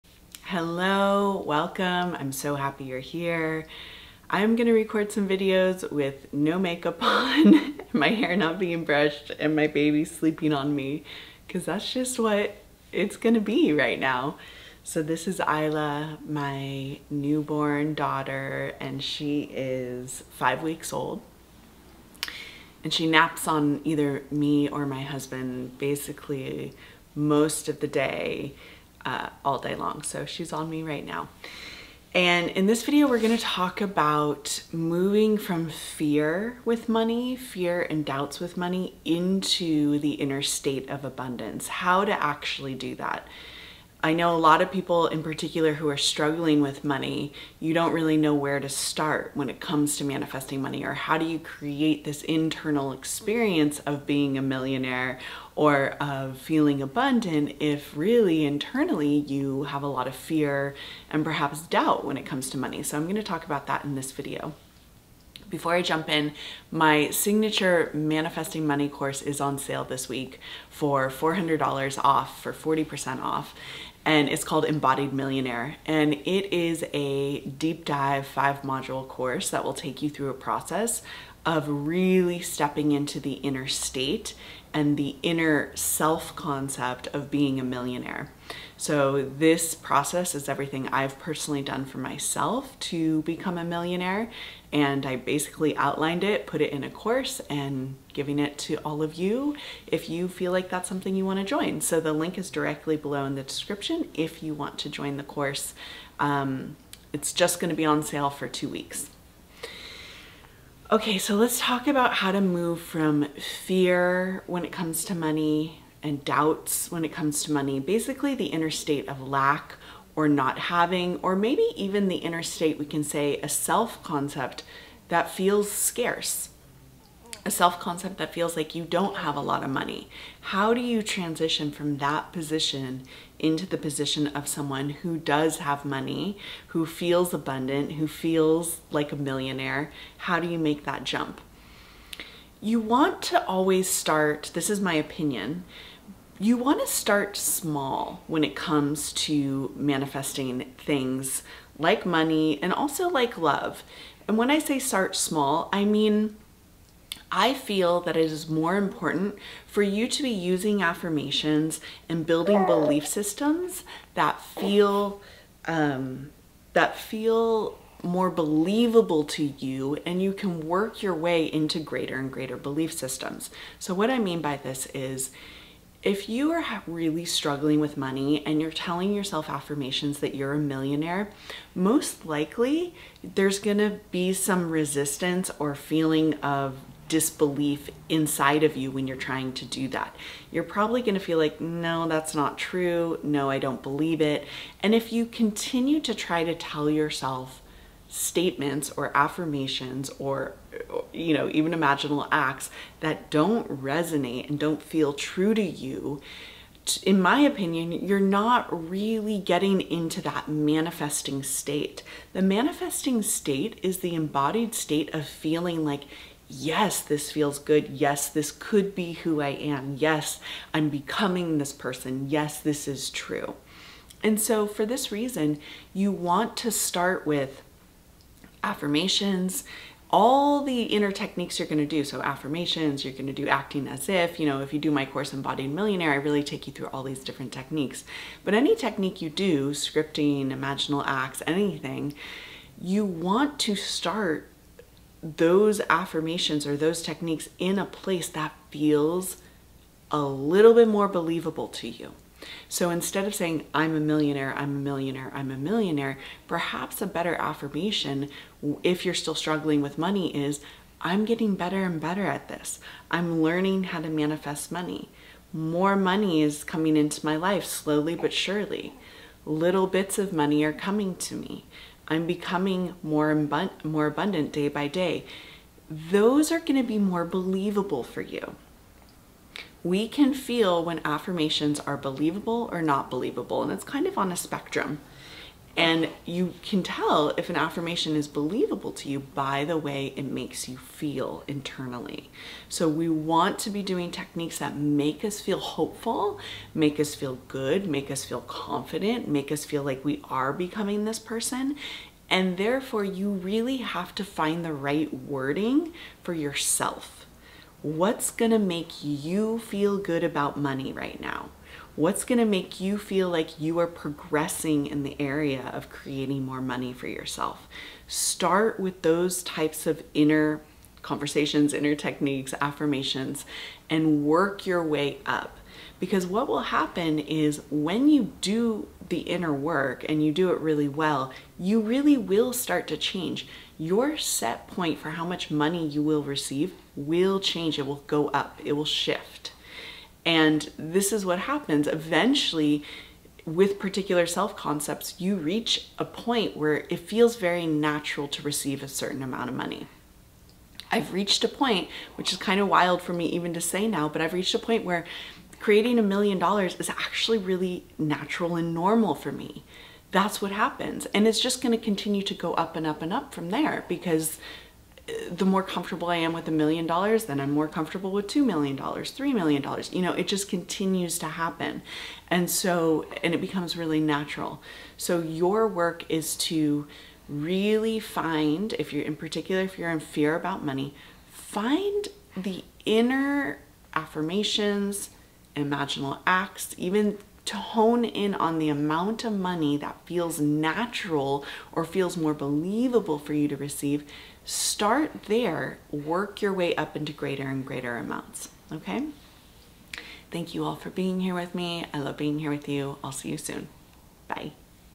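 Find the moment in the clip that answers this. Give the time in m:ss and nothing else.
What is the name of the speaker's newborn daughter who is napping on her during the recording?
0:15.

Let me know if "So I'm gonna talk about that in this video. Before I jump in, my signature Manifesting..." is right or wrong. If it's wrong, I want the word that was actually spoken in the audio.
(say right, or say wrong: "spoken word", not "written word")
right.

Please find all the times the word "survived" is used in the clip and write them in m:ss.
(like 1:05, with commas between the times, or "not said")
not said.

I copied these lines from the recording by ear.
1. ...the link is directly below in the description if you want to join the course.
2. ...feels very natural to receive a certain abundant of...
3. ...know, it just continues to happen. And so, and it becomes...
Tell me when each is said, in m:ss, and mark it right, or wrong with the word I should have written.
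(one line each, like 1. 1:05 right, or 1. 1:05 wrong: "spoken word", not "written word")
1. 1:41 right
2. 5:46 wrong: "amount", not "abundant"
3. 6:10 right.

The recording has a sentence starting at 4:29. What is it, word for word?
Little bits of money are coming to me.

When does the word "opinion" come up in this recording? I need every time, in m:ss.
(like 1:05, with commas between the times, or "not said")
2:24, 3:27.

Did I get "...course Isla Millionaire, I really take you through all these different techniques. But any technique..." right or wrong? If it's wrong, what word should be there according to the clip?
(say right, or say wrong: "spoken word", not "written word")
wrong: "Embodied", not "Isla".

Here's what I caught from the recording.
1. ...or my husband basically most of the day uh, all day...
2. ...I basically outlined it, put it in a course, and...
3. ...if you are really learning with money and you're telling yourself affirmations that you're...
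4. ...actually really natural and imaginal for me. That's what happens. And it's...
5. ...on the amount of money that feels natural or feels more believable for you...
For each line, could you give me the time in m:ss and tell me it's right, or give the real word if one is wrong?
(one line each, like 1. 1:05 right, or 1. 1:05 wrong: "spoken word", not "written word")
1. 0:24 right
2. 1:35 right
3. 2:56 wrong: "struggling", not "learning"
4. 5:56 wrong: "normal", not "imaginal"
5. 6:28 right.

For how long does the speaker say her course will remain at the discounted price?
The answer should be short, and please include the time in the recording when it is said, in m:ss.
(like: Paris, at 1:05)
2 weeks, at 1:48.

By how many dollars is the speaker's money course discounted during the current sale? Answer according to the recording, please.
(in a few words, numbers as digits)
$400.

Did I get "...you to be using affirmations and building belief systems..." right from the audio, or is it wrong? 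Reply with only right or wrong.
right.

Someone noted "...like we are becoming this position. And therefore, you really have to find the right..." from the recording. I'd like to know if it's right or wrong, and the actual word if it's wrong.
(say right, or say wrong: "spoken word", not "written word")
wrong: "person", not "position".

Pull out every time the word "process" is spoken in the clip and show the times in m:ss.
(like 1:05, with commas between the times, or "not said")
1:20, 1:29.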